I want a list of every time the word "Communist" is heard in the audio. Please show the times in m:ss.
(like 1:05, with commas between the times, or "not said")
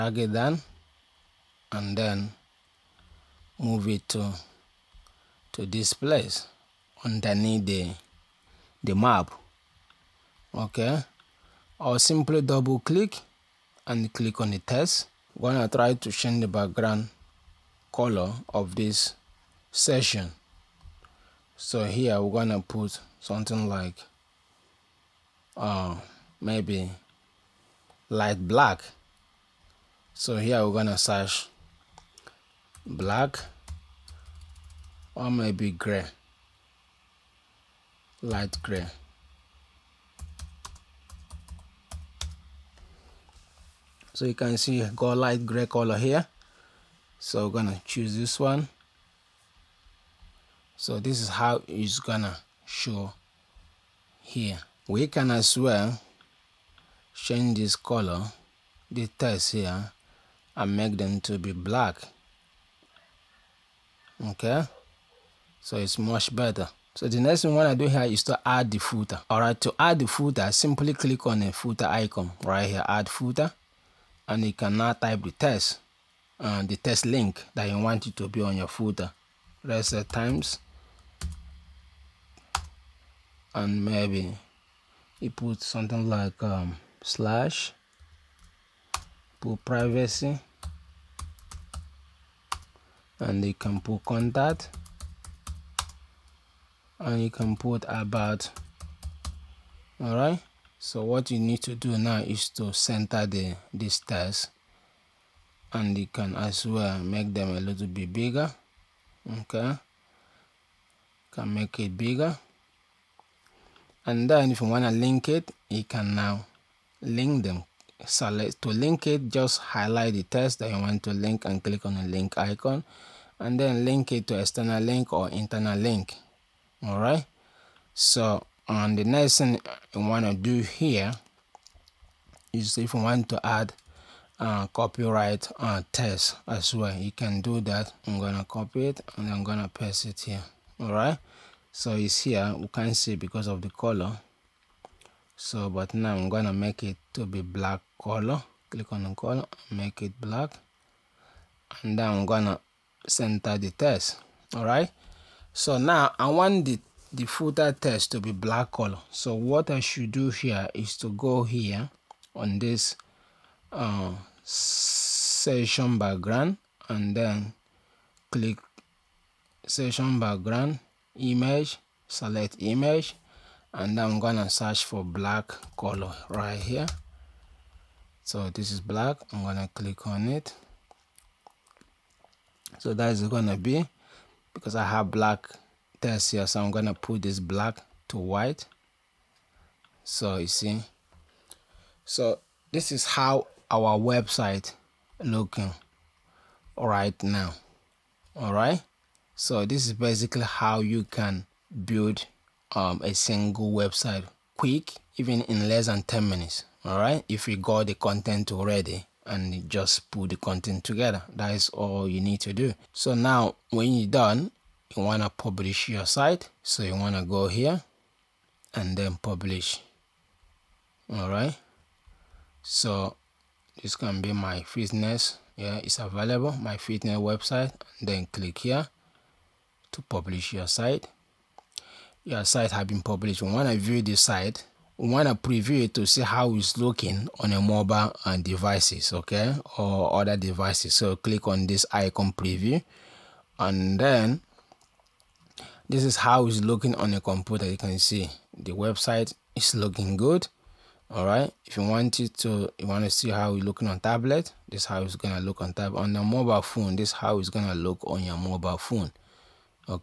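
not said.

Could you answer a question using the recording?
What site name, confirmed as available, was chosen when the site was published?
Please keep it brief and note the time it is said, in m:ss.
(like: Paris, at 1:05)
My fitness website, at 3:46.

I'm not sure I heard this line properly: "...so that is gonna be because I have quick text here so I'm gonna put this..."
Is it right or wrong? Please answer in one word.
wrong.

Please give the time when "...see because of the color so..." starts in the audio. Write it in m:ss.
2:22.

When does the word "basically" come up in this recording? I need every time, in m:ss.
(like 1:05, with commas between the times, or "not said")
3:19.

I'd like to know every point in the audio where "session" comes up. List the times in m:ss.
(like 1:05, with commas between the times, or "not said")
0:19, 2:44, 2:49.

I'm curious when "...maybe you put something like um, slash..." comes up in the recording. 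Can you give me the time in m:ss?
1:23.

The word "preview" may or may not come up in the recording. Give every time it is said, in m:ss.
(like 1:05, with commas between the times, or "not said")
3:55, 4:02.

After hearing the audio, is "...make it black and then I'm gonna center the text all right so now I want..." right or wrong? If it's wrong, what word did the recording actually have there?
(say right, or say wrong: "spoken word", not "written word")
right.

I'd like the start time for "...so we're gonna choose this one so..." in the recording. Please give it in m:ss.
0:47.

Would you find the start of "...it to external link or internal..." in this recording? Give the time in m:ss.
2:04.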